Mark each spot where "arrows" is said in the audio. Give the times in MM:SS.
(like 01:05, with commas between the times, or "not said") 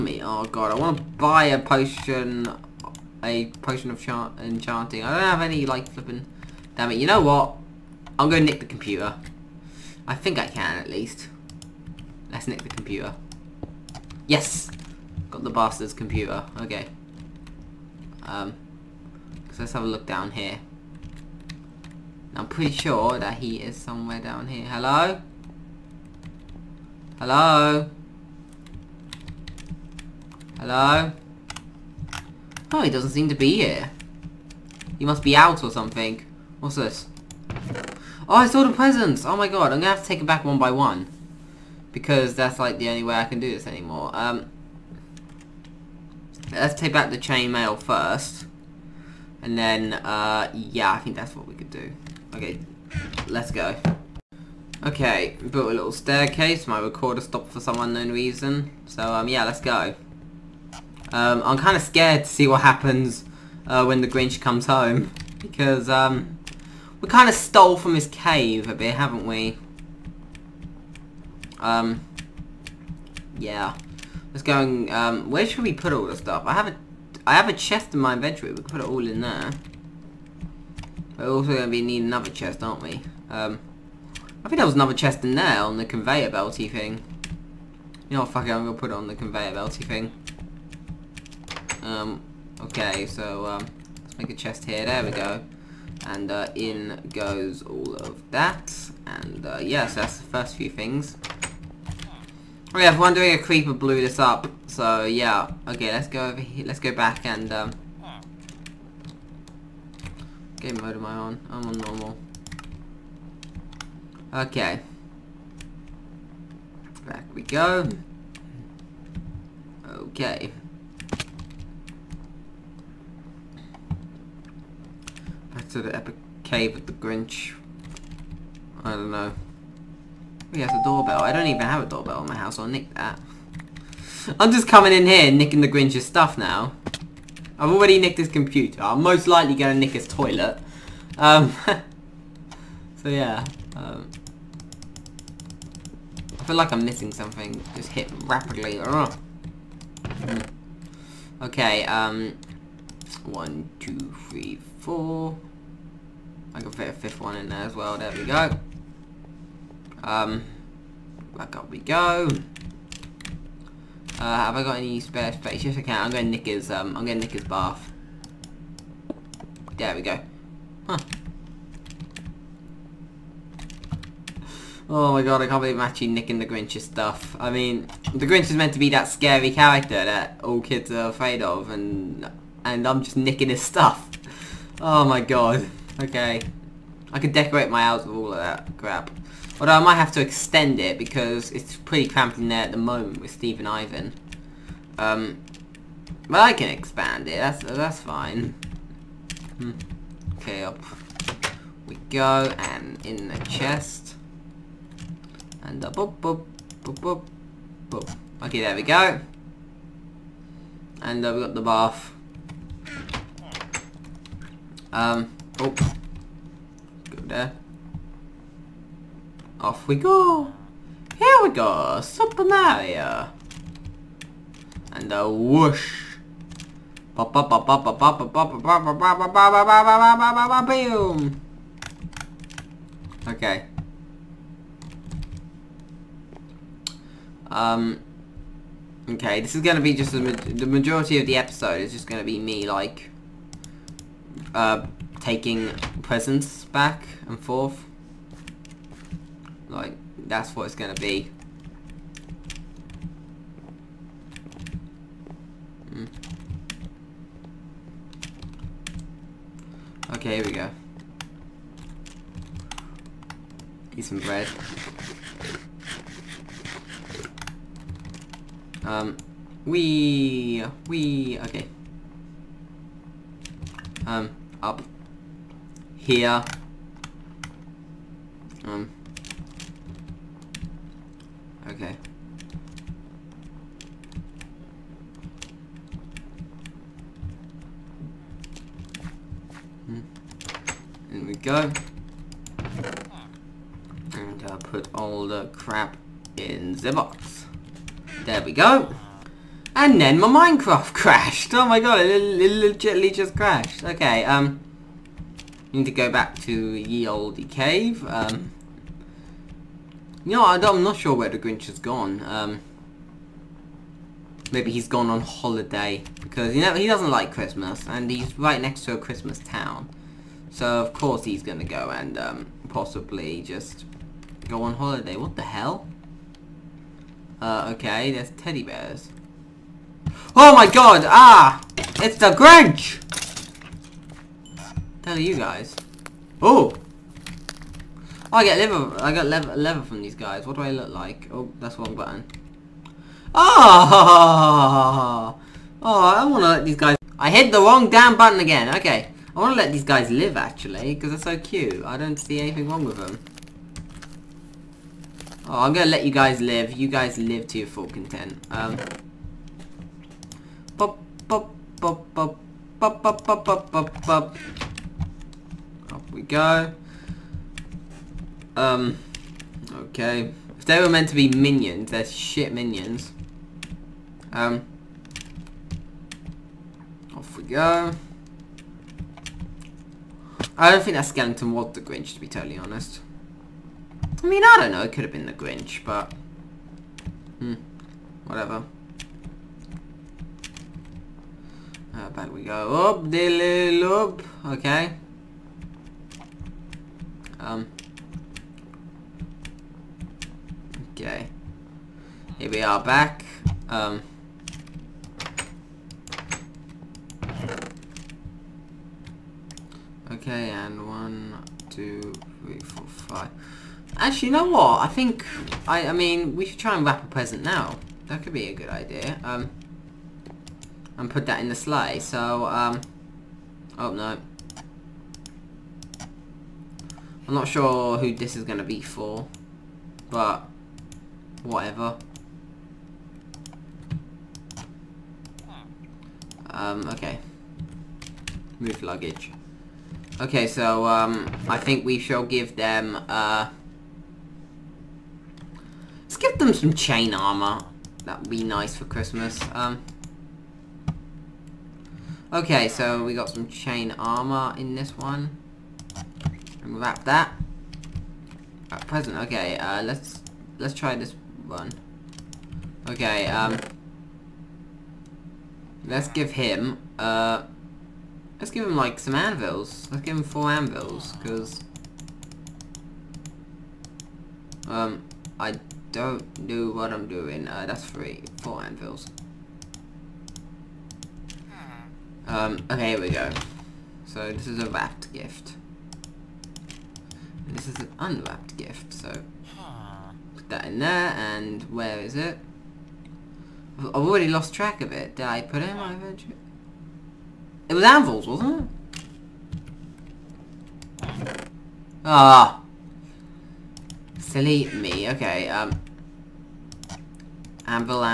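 not said.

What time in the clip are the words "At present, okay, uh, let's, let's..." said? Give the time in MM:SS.
07:38.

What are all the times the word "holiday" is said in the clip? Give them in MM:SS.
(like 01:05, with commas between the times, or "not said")
05:15, 05:24.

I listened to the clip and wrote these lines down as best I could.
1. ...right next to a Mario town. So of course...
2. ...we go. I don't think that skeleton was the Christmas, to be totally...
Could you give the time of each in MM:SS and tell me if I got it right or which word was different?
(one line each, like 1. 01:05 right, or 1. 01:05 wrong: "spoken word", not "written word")
1. 05:18 wrong: "Christmas", not "Mario"
2. 06:17 wrong: "Grinch", not "Christmas".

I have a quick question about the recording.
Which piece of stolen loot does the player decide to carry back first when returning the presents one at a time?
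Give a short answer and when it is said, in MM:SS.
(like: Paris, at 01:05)
Chainmail, at 00:47.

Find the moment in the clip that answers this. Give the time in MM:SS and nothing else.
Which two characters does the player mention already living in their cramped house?
03:13.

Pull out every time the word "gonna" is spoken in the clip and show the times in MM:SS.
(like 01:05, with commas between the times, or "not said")
00:39, 04:10, 05:21, 05:55.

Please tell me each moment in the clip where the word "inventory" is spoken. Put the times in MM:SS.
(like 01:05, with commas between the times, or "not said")
01:18, 08:15.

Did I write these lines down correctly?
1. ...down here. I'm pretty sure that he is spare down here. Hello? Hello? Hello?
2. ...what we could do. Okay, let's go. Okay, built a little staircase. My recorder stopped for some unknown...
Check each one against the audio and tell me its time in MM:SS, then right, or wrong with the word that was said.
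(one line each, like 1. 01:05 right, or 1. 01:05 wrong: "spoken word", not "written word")
1. 00:20 wrong: "somewhere", not "spare"
2. 00:51 right.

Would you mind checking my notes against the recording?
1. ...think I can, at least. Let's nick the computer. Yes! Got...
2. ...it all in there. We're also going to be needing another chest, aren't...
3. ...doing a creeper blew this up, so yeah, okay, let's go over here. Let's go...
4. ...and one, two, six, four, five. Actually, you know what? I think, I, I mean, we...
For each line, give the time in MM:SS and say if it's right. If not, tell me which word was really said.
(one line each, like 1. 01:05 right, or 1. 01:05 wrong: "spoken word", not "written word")
1. 00:10 right
2. 01:18 right
3. 01:43 right
4. 06:50 wrong: "three", not "six".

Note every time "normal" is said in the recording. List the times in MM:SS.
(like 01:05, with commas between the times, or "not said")
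01:51.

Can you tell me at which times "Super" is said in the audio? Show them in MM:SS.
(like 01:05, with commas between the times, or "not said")
03:42.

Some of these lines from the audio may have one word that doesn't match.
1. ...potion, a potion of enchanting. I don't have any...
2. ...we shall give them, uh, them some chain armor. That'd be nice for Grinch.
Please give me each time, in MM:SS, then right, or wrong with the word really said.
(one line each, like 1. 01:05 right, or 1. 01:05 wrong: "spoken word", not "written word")
1. 00:01 right
2. 07:21 wrong: "Christmas", not "Grinch".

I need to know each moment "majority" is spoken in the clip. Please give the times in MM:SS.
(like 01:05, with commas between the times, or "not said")
04:00.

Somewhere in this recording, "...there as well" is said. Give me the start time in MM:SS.
02:37.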